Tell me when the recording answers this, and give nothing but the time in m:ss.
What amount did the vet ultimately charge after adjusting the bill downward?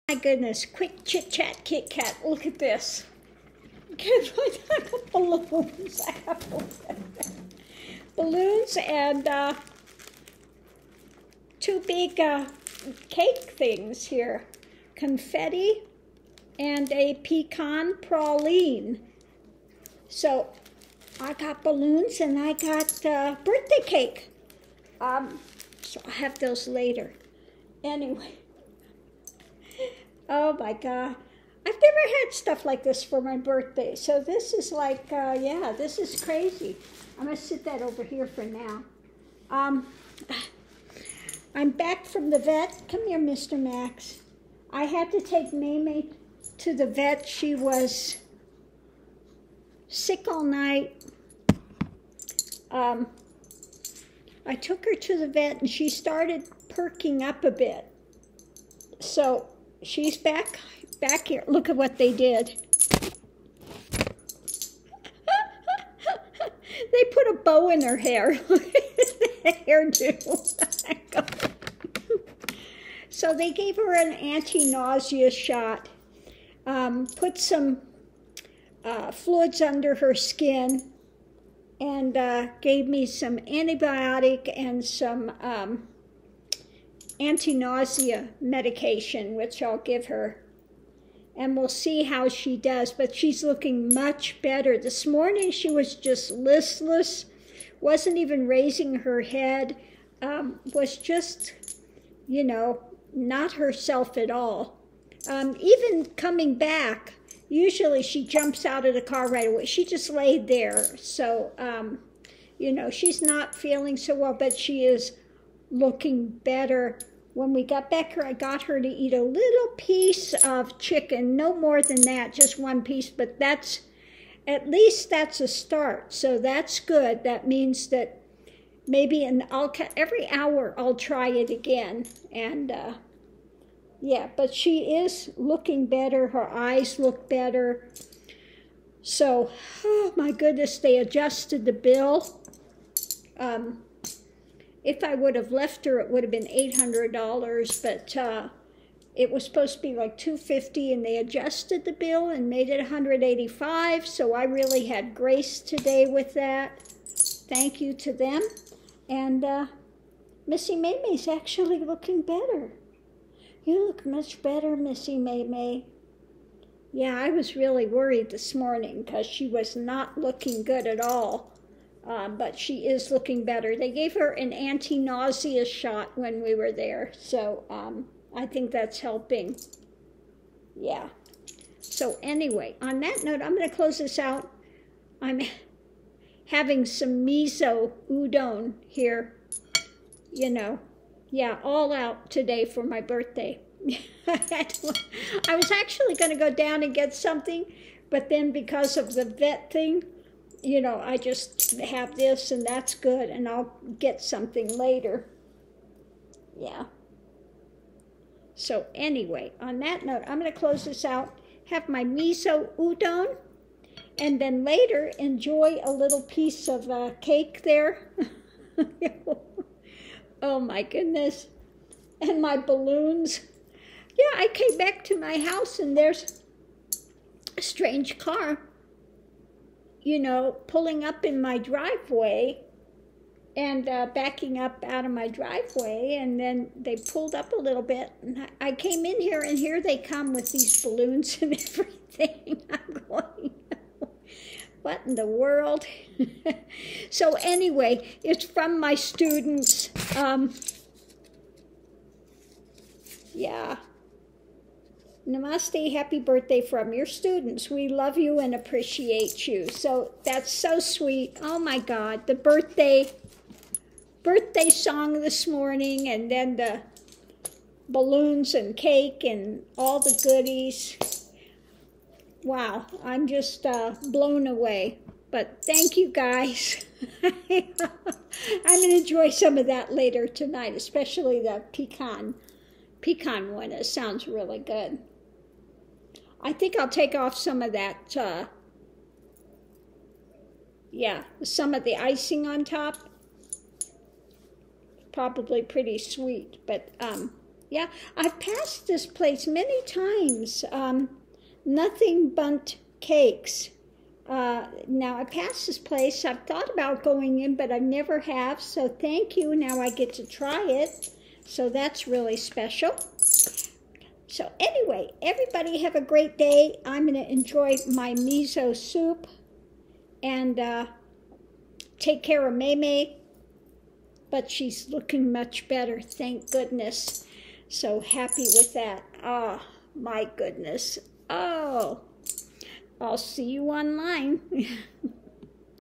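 2:32.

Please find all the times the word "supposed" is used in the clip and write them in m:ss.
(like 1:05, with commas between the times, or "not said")
2:29.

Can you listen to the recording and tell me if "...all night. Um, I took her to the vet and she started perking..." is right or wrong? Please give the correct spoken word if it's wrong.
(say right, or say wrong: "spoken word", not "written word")
right.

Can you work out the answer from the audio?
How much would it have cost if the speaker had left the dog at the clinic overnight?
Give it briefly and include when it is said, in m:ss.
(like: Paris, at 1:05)
$800, at 2:26.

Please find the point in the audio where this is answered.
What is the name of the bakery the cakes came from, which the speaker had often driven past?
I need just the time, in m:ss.
5:01.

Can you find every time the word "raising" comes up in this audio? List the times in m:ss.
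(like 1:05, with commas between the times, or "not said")
1:38.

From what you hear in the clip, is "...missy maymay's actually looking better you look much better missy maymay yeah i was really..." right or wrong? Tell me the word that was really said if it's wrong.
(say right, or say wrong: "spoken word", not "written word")
right.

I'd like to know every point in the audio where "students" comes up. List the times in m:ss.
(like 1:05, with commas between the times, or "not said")
4:08, 4:17.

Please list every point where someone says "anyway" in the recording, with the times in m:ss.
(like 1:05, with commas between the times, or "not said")
0:27, 3:02, 3:28, 4:07, 5:14.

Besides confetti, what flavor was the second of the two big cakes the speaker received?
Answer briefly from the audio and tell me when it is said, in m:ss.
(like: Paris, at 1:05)
Pecan praline, at 0:17.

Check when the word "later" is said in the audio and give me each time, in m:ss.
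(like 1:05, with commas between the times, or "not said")
0:26, 3:24, 3:34, 4:39.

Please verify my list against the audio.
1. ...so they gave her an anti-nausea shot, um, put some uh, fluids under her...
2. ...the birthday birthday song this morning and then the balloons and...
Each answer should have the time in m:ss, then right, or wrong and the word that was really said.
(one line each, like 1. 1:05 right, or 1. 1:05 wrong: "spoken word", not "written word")
1. 1:13 right
2. 4:22 right.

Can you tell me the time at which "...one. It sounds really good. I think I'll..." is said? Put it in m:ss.
4:43.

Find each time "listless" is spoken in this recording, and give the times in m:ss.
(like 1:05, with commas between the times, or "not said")
1:36.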